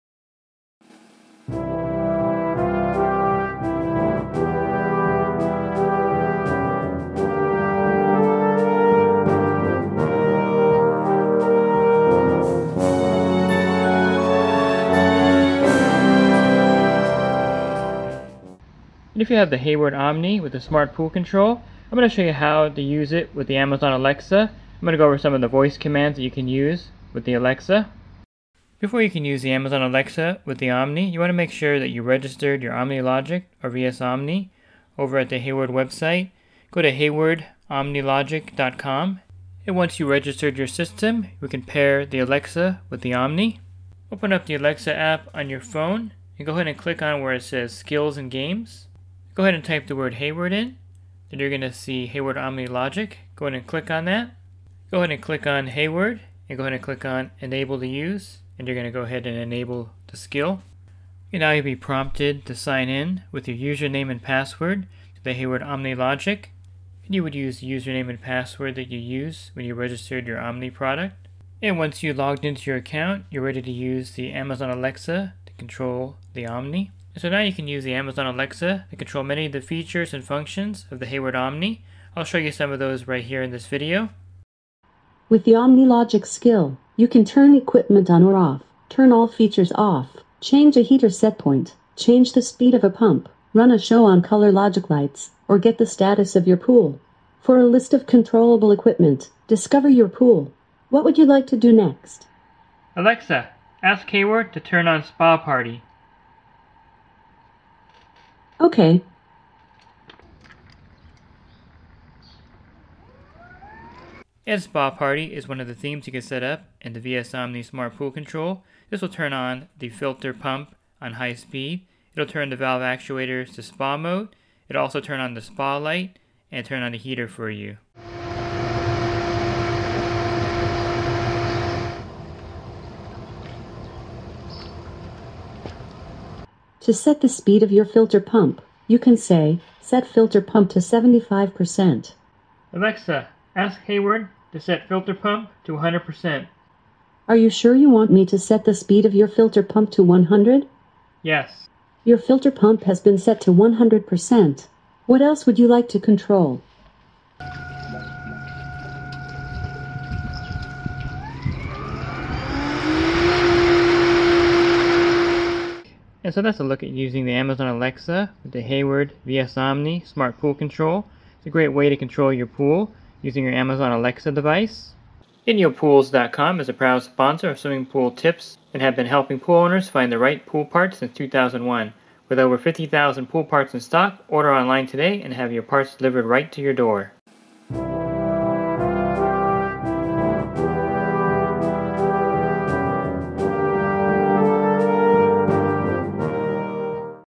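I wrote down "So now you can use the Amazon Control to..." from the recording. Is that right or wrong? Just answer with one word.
wrong.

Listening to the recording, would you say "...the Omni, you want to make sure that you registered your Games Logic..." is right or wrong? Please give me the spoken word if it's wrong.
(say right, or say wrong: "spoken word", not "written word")
wrong: "Omni", not "Games".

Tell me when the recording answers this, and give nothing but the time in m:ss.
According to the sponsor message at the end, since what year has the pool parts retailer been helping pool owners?
3:00.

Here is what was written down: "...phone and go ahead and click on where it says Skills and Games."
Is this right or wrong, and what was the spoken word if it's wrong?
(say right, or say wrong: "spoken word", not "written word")
right.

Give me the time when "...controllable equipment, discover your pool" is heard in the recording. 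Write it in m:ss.
1:38.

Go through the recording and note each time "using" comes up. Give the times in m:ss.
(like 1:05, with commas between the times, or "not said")
2:46, 2:53.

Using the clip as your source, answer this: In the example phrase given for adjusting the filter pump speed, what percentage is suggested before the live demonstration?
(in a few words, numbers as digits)
75%.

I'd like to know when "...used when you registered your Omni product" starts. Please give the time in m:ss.
1:08.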